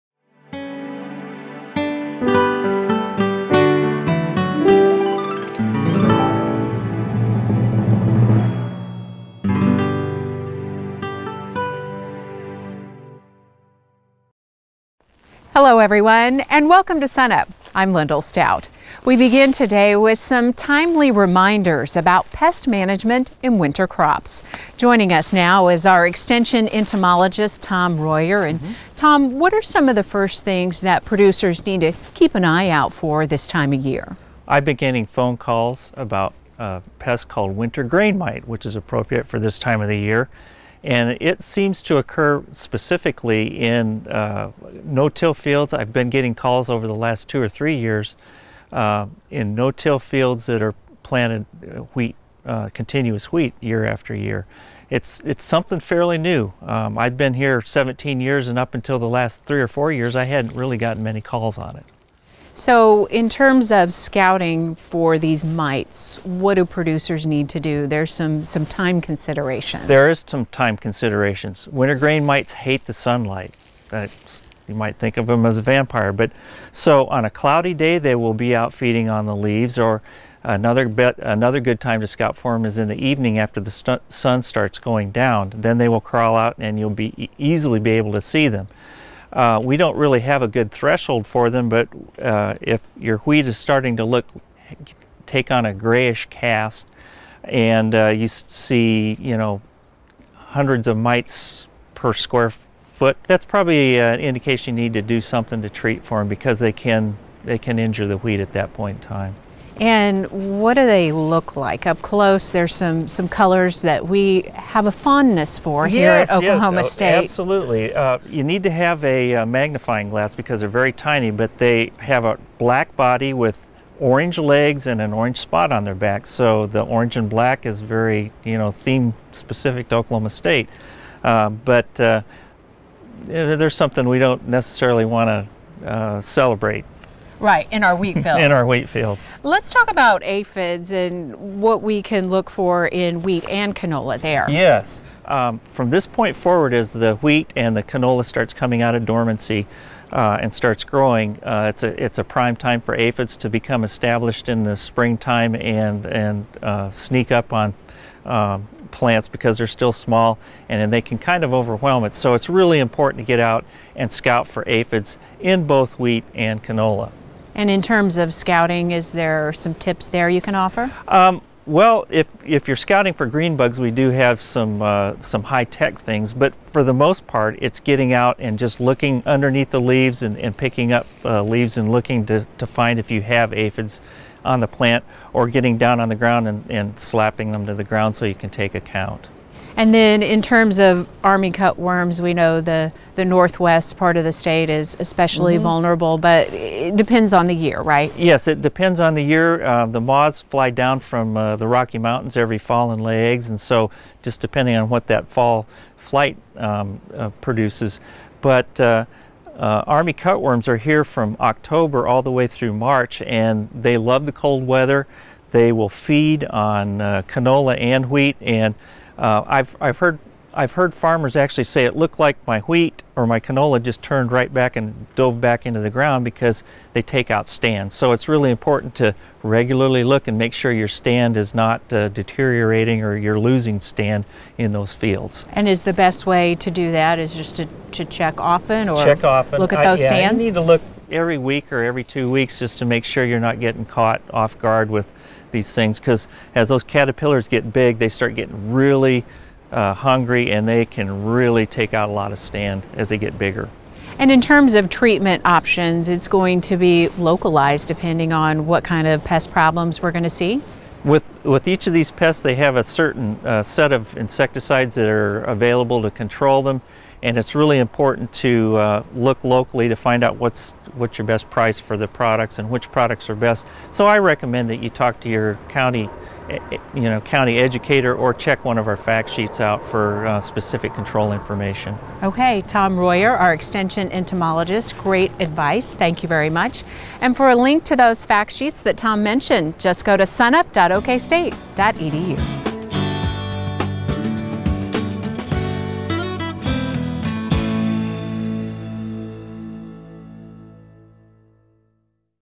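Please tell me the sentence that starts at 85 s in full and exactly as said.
Then they will crawl out, and you'll be easily be able to see them.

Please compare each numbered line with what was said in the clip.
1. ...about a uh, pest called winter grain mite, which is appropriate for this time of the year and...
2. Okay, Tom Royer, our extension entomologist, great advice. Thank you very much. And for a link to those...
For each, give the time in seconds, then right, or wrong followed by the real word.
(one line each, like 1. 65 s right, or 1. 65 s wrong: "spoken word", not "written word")
1. 35 s right
2. 282 s right.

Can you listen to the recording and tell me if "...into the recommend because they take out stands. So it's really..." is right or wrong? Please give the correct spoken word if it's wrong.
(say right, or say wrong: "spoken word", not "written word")
wrong: "ground", not "recommend".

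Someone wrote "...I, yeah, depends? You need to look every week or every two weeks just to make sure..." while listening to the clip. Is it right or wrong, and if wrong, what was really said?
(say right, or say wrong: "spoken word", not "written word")
wrong: "stands", not "depends".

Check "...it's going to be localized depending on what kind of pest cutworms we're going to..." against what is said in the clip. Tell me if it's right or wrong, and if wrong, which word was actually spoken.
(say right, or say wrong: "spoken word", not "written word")
wrong: "problems", not "cutworms".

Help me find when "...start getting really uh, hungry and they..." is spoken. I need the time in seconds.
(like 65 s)
248 s.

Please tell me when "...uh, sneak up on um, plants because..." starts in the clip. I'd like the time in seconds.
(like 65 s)
156 s.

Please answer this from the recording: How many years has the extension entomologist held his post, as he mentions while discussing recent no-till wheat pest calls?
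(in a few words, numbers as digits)
17.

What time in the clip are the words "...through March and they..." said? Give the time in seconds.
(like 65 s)
212 s.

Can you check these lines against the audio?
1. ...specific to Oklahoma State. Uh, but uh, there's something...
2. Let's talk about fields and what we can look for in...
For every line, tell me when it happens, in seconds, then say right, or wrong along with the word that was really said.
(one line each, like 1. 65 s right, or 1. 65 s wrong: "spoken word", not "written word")
1. 129 s right
2. 139 s wrong: "aphids", not "fields".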